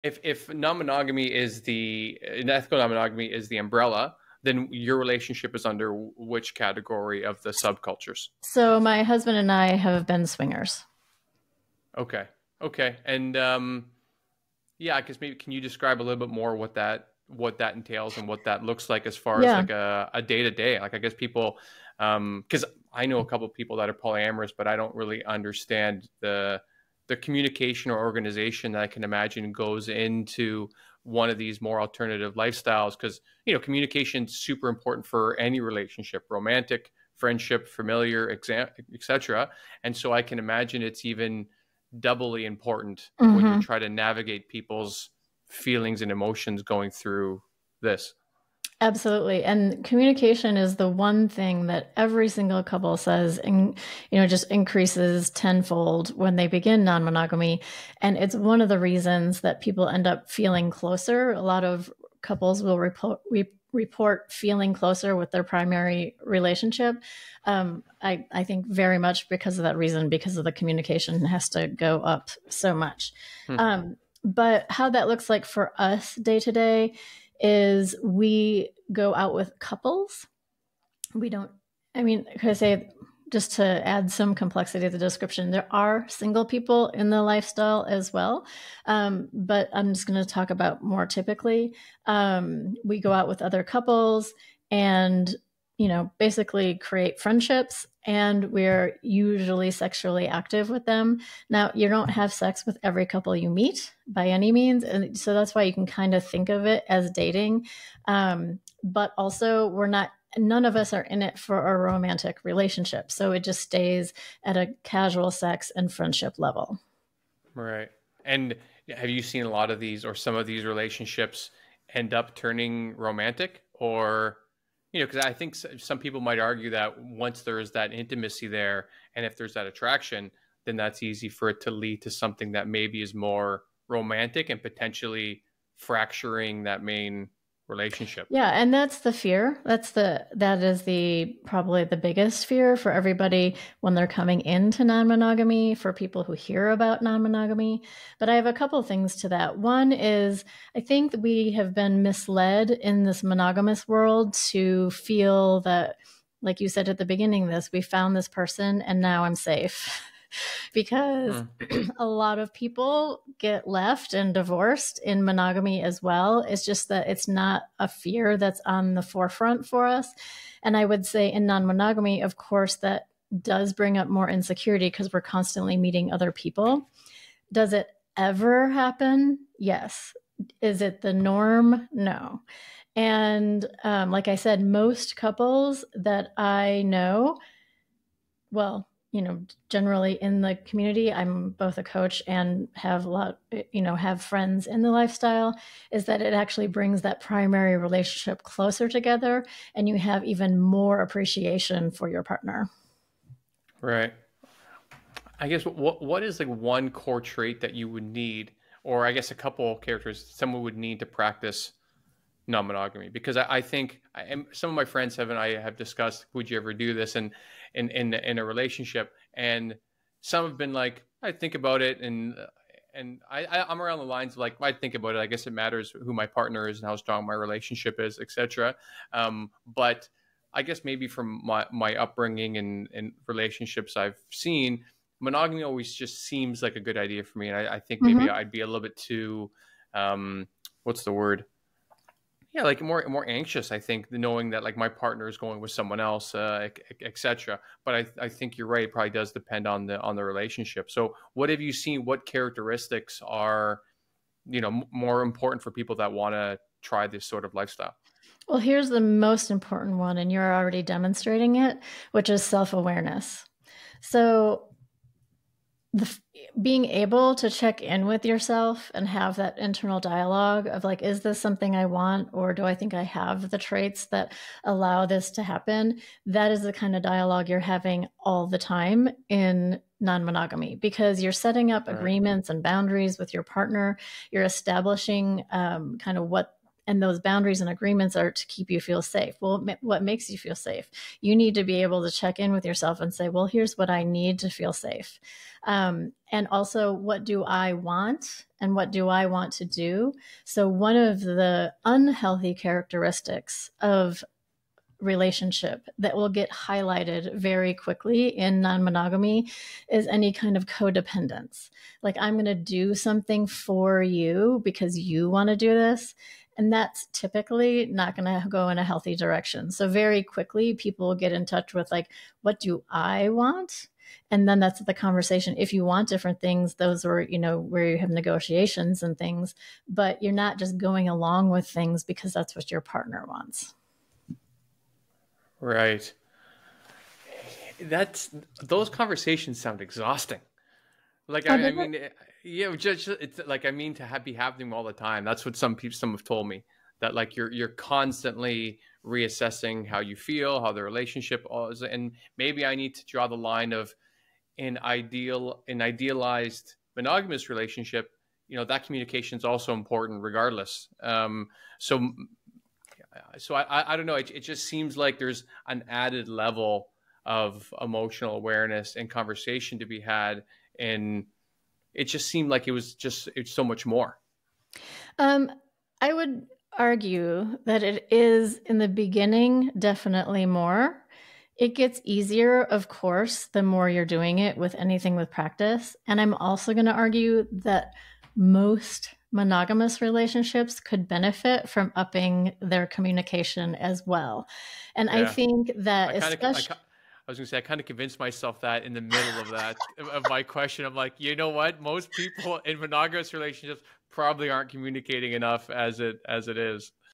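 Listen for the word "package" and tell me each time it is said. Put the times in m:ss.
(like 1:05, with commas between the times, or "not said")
not said.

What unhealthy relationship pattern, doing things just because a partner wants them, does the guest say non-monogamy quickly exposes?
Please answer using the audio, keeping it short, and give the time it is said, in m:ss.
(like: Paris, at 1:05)
Codependence, at 5:10.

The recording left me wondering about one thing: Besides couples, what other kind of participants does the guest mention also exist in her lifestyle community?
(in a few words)
Single people.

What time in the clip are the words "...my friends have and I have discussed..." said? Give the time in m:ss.
3:34.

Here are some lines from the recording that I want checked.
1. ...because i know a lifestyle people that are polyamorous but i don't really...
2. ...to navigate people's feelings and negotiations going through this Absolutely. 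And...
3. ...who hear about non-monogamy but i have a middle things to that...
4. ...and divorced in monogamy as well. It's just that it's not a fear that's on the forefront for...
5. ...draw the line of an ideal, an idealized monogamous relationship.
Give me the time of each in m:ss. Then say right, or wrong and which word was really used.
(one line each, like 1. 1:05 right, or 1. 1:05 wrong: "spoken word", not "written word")
1. 0:22 wrong: "couple", not "lifestyle"
2. 0:43 wrong: "emotions", not "negotiations"
3. 2:26 wrong: "couple", not "middle"
4. 2:44 right
5. 5:53 right.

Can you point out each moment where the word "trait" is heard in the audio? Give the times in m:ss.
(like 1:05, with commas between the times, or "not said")
3:27, 4:33.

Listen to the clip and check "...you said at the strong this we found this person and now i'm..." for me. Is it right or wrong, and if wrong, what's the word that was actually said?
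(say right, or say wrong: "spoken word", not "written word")
wrong: "beginning", not "strong".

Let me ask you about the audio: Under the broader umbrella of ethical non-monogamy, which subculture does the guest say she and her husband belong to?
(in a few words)
Swingers.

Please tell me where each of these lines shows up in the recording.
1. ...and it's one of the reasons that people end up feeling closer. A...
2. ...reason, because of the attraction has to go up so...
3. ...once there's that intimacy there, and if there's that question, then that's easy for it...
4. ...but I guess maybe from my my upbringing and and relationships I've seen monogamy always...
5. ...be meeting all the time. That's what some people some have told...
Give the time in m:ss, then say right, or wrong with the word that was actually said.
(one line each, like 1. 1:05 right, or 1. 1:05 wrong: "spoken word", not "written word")
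1. 0:58 right
2. 1:09 wrong: "communication", not "attraction"
3. 2:07 wrong: "attraction", not "question"
4. 3:49 right
5. 5:44 wrong: "happening", not "meeting".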